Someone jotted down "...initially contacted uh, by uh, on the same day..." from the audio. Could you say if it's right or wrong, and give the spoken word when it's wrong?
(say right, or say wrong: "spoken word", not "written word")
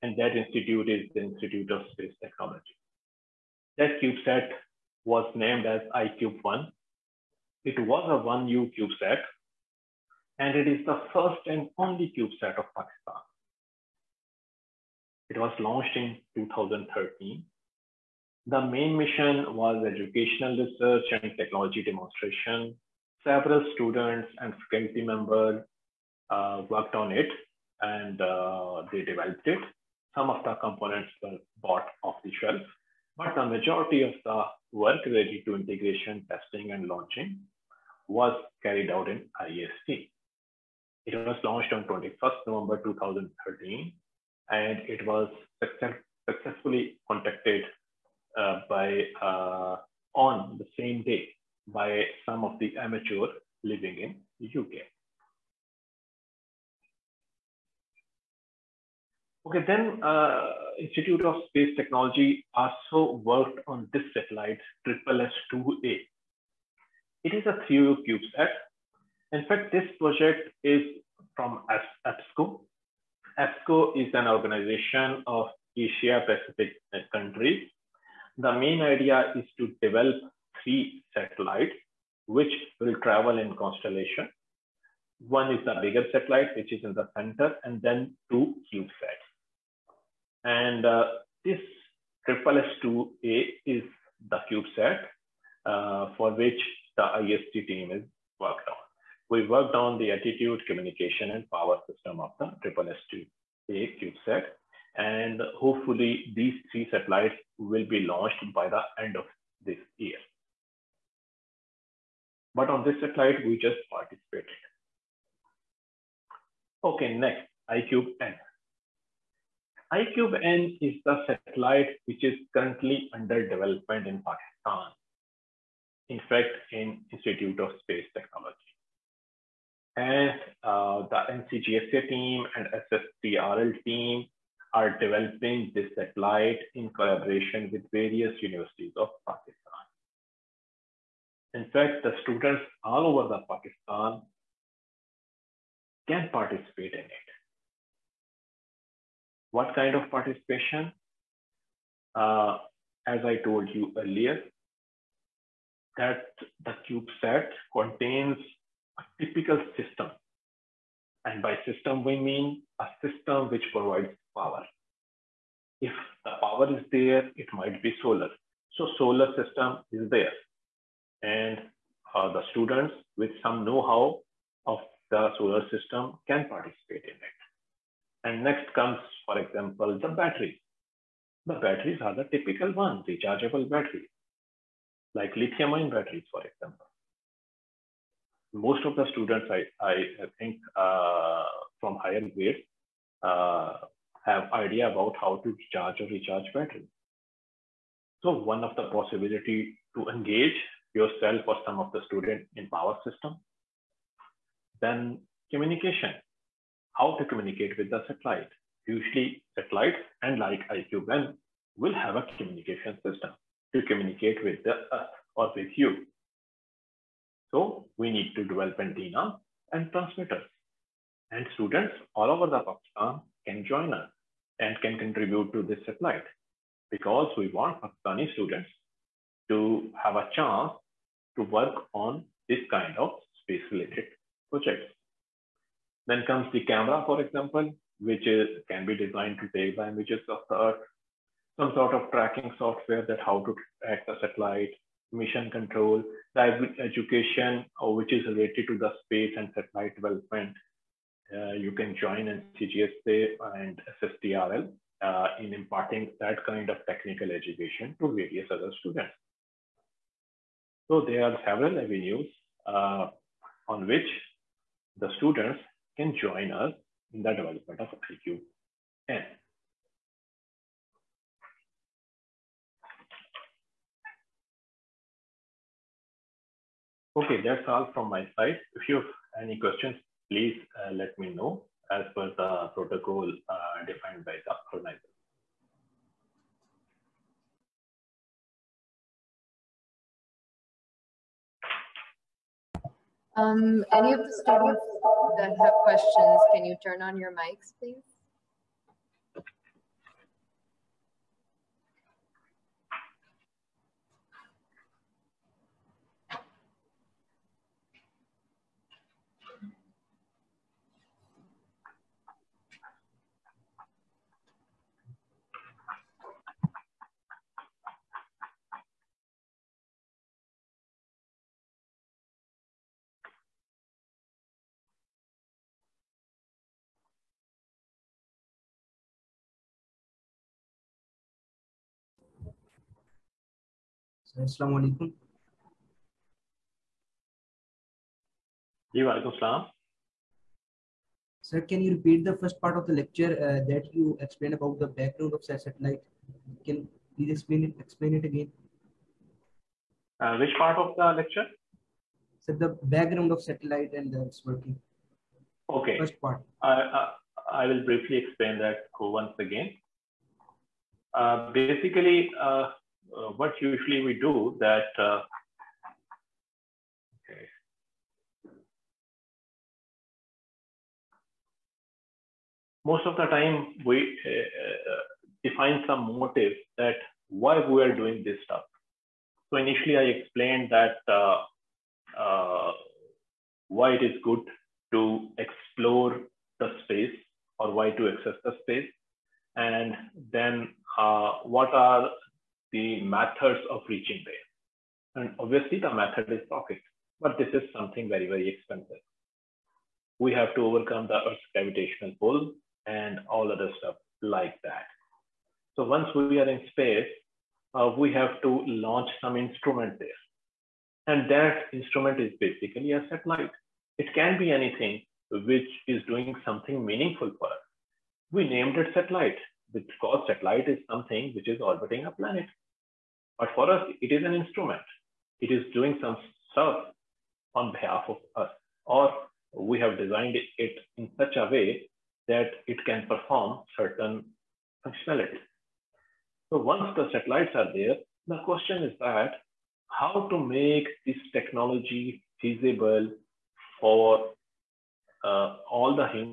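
wrong: "successfully", not "initially".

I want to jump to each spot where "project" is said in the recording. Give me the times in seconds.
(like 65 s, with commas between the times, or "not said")
69 s, 234 s.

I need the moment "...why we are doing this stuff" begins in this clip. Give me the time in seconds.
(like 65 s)
377 s.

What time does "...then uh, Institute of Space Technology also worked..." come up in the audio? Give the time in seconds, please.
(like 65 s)
59 s.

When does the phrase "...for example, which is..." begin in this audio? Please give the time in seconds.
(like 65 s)
237 s.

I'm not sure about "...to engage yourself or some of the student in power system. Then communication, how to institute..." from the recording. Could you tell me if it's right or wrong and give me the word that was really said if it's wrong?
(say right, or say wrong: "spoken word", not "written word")
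wrong: "communicate", not "institute".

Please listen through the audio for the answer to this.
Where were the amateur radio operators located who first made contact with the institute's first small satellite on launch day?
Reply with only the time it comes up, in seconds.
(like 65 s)
54 s.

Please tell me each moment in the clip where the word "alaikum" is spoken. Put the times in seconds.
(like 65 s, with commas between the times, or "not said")
334 s.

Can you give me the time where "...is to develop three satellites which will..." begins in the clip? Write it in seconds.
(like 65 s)
79 s.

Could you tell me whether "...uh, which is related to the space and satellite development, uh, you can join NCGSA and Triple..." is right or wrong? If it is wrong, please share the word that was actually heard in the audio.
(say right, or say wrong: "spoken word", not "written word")
wrong: "SSTRL", not "Triple".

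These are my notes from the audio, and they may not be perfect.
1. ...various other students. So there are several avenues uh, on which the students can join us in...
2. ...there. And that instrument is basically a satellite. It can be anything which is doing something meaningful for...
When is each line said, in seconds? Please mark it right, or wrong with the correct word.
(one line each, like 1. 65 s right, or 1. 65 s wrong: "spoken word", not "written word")
1. 258 s right
2. 409 s right.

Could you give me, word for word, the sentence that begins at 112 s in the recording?
But on this satellite, we just participated.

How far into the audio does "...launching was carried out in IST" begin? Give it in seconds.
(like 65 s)
36 s.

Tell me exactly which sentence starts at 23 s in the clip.
Several students and faculty members uh, worked on it and uh, they developed it.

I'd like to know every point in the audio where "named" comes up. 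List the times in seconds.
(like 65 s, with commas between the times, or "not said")
5 s, 418 s.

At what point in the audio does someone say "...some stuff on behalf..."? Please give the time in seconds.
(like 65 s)
426 s.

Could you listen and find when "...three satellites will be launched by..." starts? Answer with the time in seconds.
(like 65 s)
106 s.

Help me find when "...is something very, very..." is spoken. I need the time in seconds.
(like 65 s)
397 s.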